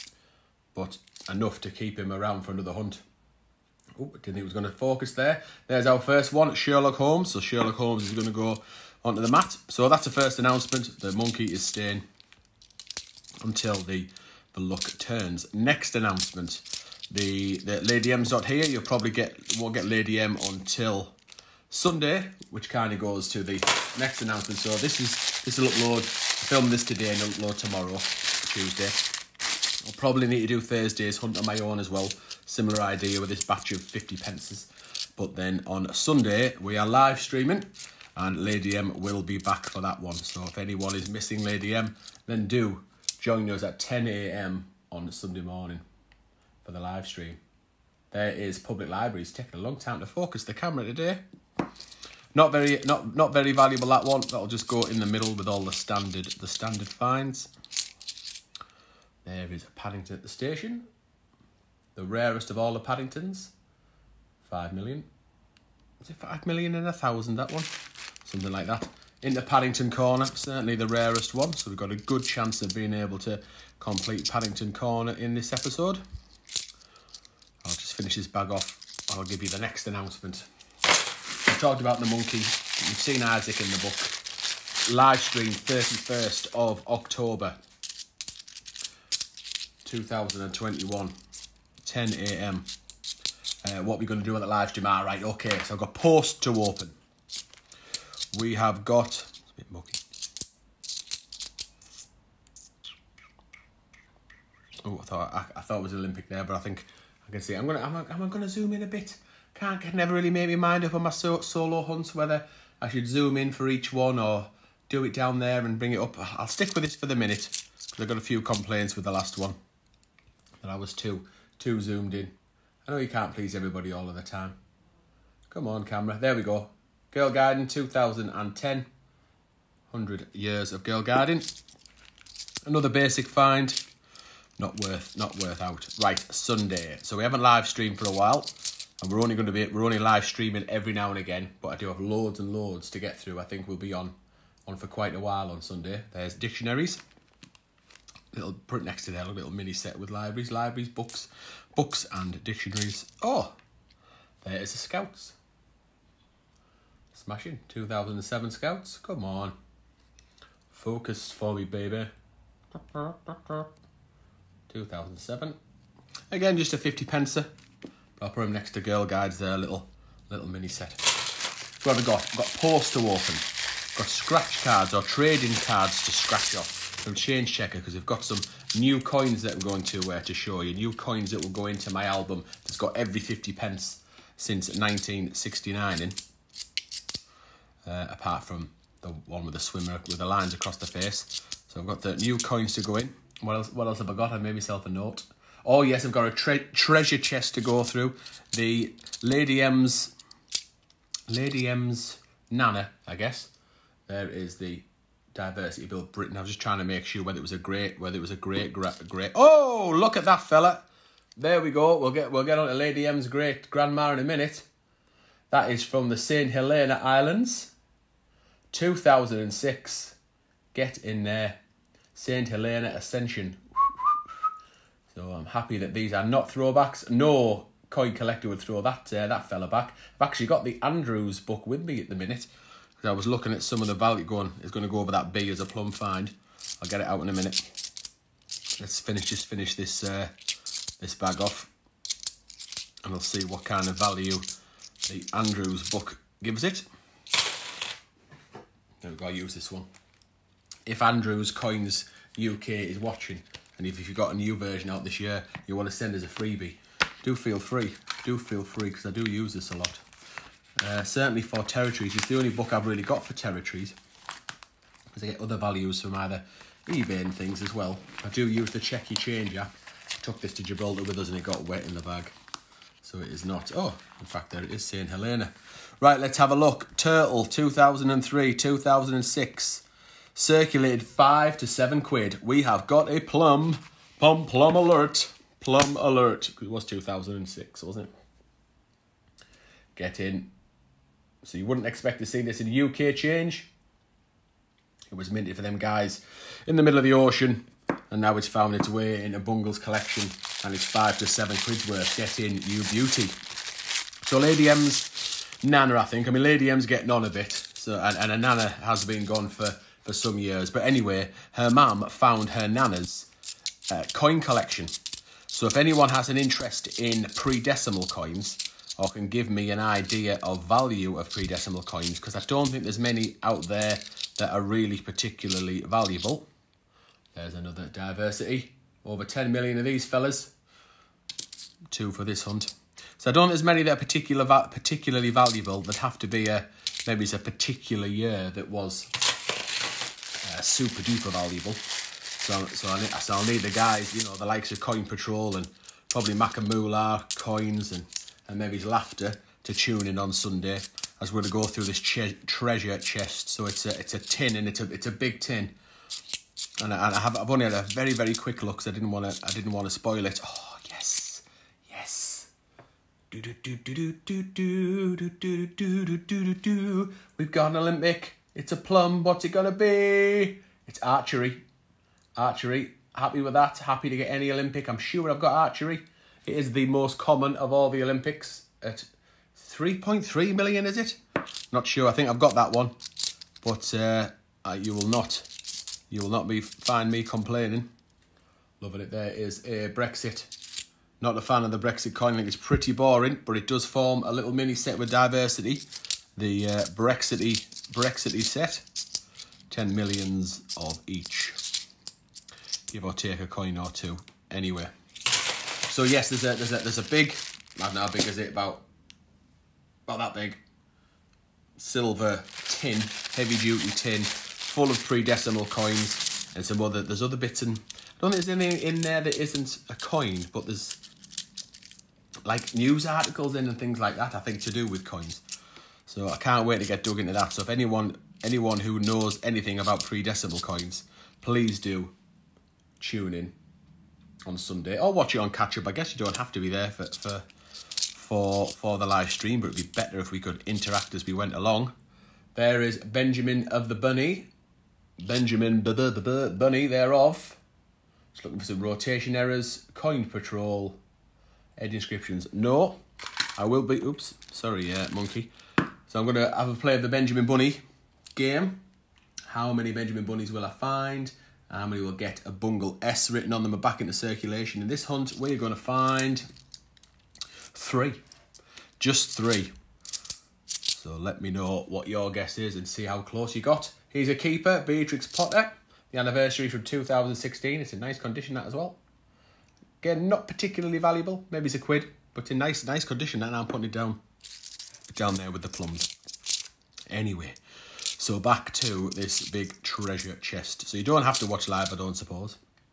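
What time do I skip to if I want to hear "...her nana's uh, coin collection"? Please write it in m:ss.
5:12.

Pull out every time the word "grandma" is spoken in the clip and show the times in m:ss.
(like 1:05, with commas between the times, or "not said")
3:33.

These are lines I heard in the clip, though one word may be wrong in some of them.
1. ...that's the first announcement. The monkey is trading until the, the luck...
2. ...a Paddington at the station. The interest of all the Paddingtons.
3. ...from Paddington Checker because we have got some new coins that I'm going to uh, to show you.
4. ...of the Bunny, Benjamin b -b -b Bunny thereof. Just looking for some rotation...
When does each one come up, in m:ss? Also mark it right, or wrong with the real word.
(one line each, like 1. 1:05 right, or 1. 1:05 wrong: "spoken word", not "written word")
1. 0:09 wrong: "staying", not "trading"
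2. 0:59 wrong: "rarest", not "interest"
3. 2:56 wrong: "Change", not "Paddington"
4. 7:23 right.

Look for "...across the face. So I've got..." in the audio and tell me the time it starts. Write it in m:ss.
3:10.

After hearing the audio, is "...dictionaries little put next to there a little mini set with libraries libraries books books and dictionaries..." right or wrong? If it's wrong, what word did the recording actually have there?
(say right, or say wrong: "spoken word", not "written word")
right.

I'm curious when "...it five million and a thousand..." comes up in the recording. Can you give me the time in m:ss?
1:06.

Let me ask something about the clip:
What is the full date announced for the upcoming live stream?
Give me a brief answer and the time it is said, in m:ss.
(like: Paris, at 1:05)
31 October 2021, at 1:25.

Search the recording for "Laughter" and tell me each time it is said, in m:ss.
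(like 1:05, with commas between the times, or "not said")
5:48.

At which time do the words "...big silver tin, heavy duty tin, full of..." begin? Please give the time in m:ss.
6:50.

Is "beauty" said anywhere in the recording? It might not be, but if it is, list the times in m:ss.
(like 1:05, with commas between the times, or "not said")
5:02.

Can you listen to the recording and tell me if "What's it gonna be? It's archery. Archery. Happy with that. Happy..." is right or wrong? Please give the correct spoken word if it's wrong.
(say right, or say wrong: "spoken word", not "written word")
right.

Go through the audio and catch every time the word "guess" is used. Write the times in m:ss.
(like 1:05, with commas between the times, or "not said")
3:23, 7:15, 7:52.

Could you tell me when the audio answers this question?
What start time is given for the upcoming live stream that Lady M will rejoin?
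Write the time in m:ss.
0:43.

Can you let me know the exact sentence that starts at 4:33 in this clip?
Oh, in fact, there it is, St.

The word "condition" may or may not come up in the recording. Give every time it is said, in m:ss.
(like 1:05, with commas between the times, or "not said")
7:58, 8:03.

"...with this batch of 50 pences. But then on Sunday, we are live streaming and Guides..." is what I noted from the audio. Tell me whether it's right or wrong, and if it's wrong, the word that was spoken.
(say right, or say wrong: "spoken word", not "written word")
wrong: "Lady", not "Guides".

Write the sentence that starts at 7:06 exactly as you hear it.
So I can't wait to get dug into that.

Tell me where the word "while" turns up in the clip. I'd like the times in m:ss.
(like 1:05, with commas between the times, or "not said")
2:18, 2:25.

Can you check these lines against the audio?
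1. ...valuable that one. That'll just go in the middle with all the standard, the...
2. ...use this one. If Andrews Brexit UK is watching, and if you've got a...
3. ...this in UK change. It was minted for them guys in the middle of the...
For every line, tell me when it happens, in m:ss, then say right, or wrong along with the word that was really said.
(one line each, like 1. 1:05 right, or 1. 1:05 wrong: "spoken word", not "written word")
1. 0:53 right
2. 4:09 wrong: "Coins", not "Brexit"
3. 4:52 right.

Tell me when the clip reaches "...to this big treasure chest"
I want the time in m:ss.
8:08.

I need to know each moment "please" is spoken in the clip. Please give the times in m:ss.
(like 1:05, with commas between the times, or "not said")
2:03, 7:11.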